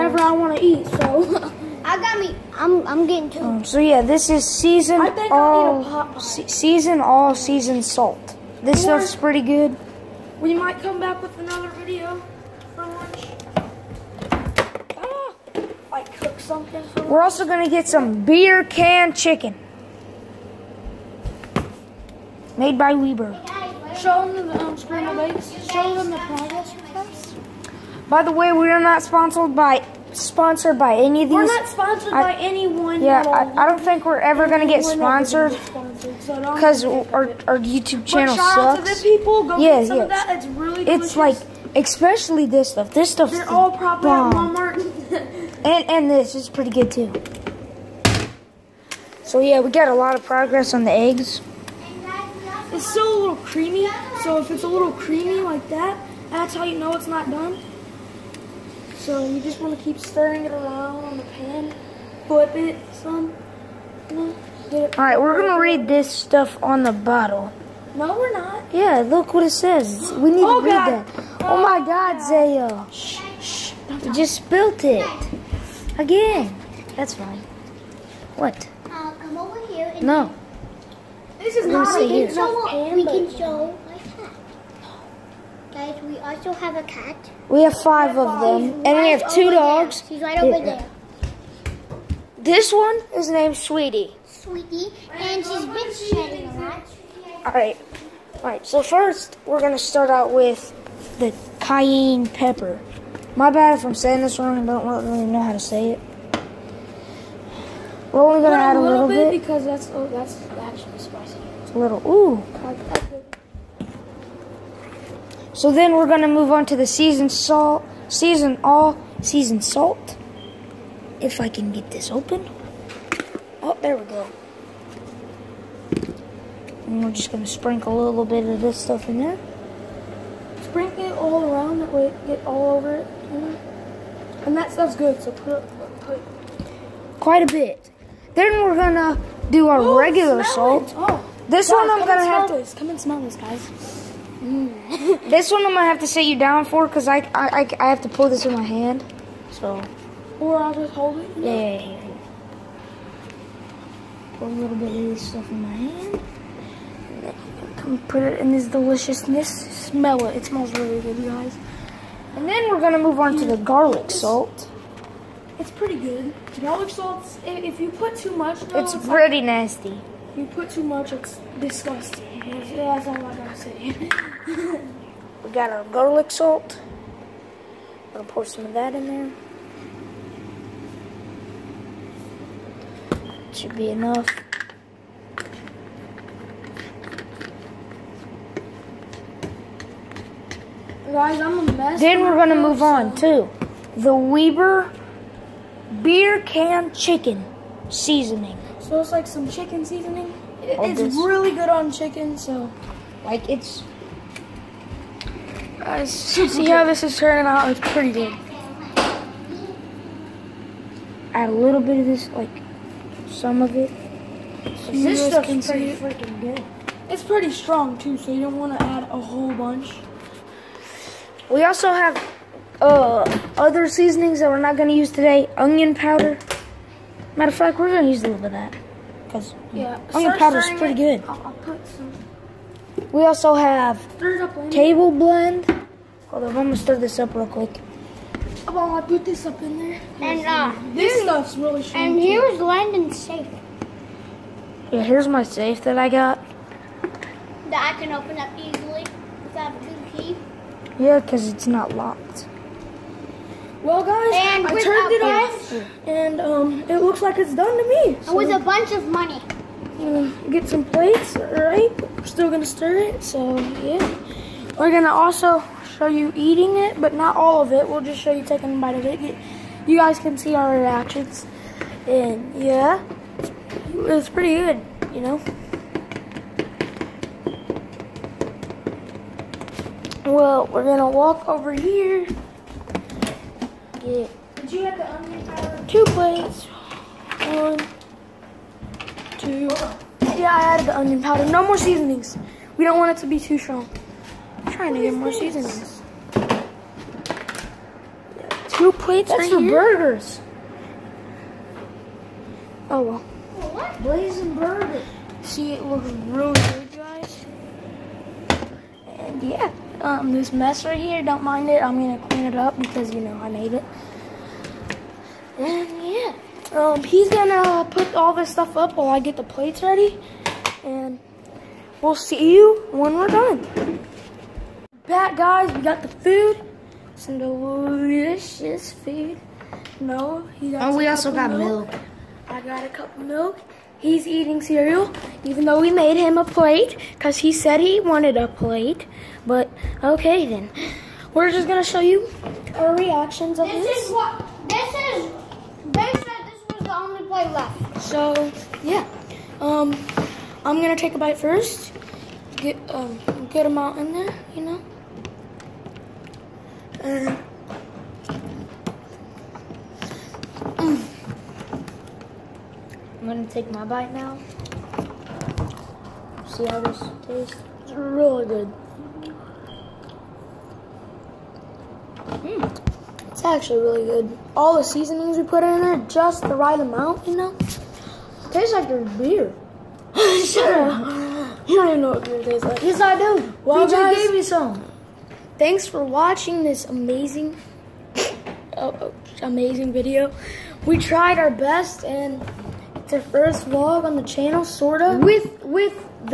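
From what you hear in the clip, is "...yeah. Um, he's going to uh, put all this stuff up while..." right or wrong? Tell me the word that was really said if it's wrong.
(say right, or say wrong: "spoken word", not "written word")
right.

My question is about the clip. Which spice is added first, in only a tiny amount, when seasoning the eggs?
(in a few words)
Cayenne pepper.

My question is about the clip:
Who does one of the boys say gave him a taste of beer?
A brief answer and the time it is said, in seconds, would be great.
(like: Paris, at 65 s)
PJ, at 383 s.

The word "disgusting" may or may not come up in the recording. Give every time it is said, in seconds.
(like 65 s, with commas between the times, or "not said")
171 s.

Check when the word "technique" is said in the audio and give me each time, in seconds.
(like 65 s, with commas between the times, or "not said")
not said.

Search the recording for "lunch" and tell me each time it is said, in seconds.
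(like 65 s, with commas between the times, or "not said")
12 s, 17 s.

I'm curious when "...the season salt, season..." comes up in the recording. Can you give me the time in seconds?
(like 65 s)
116 s.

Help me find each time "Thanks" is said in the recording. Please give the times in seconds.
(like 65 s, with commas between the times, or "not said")
385 s.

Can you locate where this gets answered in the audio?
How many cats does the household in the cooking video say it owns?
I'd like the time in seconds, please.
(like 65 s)
87 s.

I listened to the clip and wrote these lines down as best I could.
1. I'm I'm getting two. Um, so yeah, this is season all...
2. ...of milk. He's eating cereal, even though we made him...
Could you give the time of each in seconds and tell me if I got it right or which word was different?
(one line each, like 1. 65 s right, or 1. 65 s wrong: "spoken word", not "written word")
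1. 2 s right
2. 333 s right.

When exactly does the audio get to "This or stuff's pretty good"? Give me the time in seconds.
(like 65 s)
8 s.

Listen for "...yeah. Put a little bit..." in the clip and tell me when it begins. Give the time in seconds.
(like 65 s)
152 s.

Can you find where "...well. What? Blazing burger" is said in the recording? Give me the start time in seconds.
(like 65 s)
303 s.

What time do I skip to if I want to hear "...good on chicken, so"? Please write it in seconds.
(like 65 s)
201 s.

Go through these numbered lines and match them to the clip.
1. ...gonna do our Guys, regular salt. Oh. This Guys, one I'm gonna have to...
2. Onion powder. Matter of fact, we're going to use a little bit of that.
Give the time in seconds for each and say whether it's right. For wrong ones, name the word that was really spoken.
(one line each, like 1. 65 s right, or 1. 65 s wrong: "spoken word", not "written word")
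1. 138 s wrong: "Ooh", not "Guys"
2. 225 s right.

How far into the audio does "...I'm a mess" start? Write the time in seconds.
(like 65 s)
191 s.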